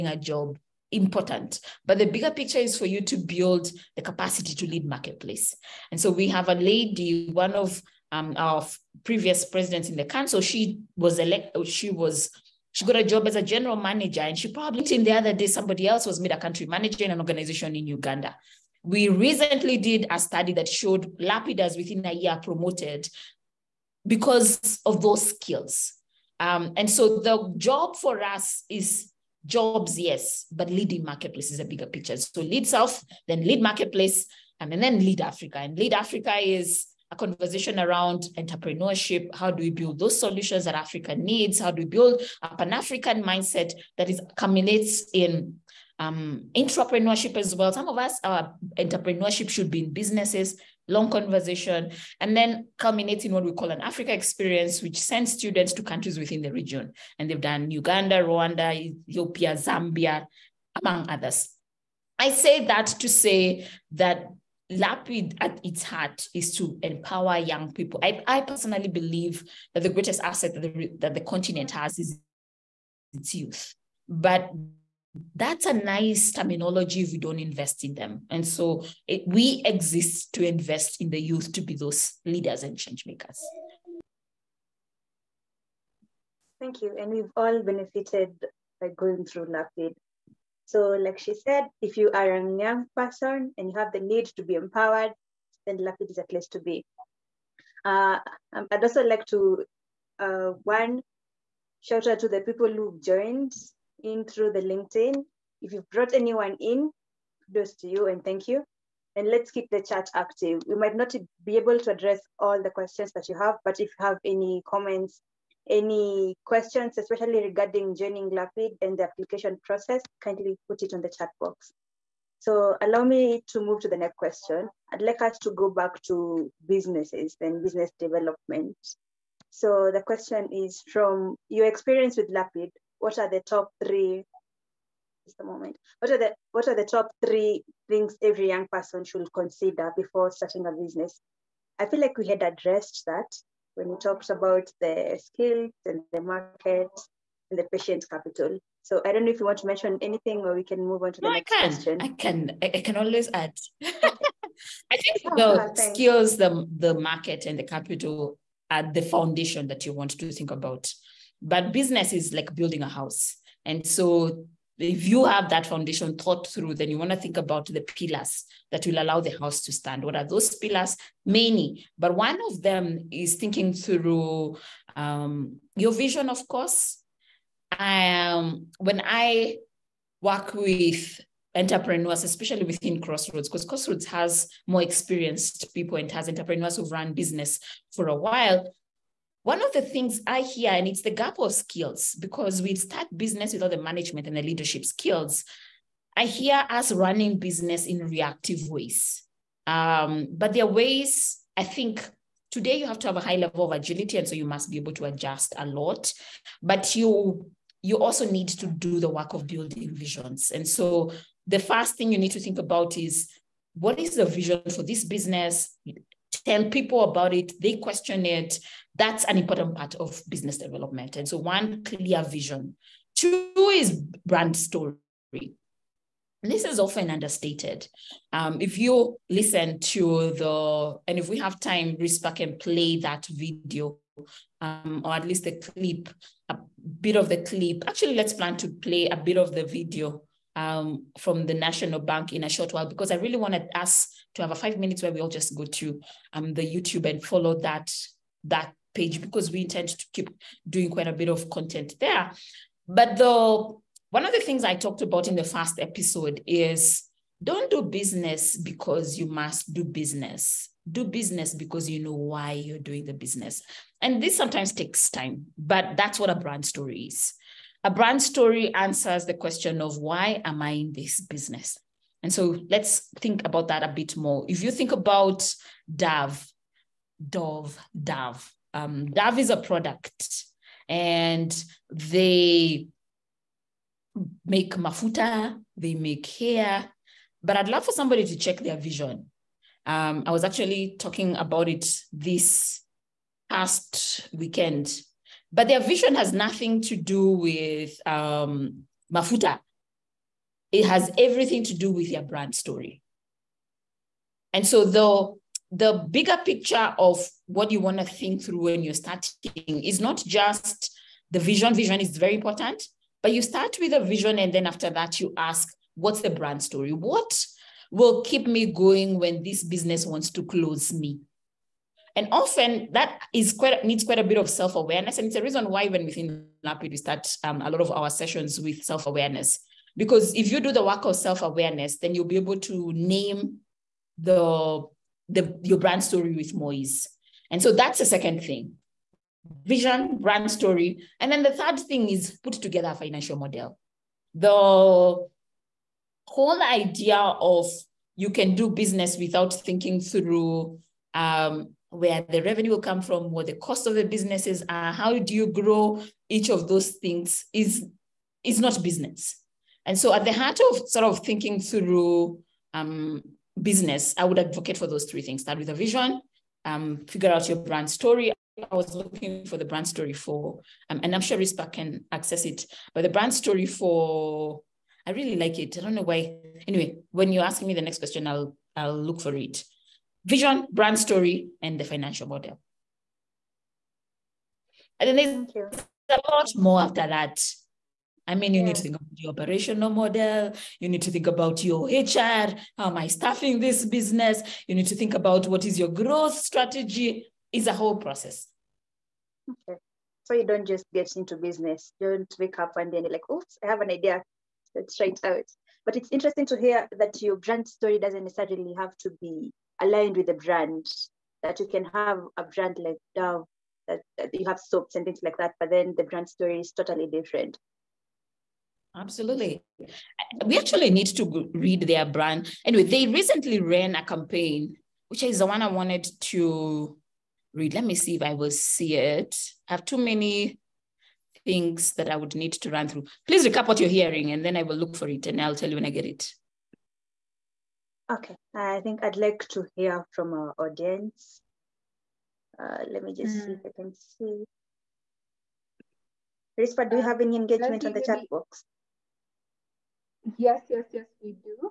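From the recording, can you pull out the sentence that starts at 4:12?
But the one of the things I talked about in the first episode is don't do business because you must do business.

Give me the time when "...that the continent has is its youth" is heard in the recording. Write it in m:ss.
1:10.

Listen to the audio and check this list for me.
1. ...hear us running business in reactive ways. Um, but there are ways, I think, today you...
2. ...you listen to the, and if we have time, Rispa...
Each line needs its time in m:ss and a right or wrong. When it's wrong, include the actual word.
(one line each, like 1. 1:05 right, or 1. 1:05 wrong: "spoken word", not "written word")
1. 3:16 right
2. 3:48 right.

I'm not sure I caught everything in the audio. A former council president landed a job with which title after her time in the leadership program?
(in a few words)
General manager.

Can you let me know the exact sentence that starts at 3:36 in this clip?
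tell people about it, they question it.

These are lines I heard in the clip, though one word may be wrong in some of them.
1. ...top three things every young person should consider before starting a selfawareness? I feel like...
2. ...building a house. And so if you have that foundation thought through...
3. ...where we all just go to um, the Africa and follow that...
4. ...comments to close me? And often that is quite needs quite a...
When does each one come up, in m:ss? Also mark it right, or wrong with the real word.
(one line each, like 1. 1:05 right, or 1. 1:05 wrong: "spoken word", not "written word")
1. 2:16 wrong: "business", not "selfawareness"
2. 2:42 right
3. 4:05 wrong: "YouTube", not "Africa"
4. 5:20 wrong: "wants", not "comments".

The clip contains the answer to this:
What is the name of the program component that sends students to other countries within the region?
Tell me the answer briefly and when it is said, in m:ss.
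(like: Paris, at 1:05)
Africa experience, at 0:53.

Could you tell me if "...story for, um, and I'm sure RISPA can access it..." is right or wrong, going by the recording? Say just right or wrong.
right.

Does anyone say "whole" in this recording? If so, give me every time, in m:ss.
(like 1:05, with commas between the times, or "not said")
5:44, 6:37.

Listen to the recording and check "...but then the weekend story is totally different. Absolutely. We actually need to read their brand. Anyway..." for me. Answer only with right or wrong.
wrong.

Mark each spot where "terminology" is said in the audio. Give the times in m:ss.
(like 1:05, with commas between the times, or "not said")
1:16.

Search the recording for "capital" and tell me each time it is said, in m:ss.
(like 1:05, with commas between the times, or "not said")
2:28, 2:37.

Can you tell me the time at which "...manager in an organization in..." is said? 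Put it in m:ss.
0:16.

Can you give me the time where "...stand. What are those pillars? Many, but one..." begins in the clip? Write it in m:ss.
2:49.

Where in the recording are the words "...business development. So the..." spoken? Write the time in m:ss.
2:07.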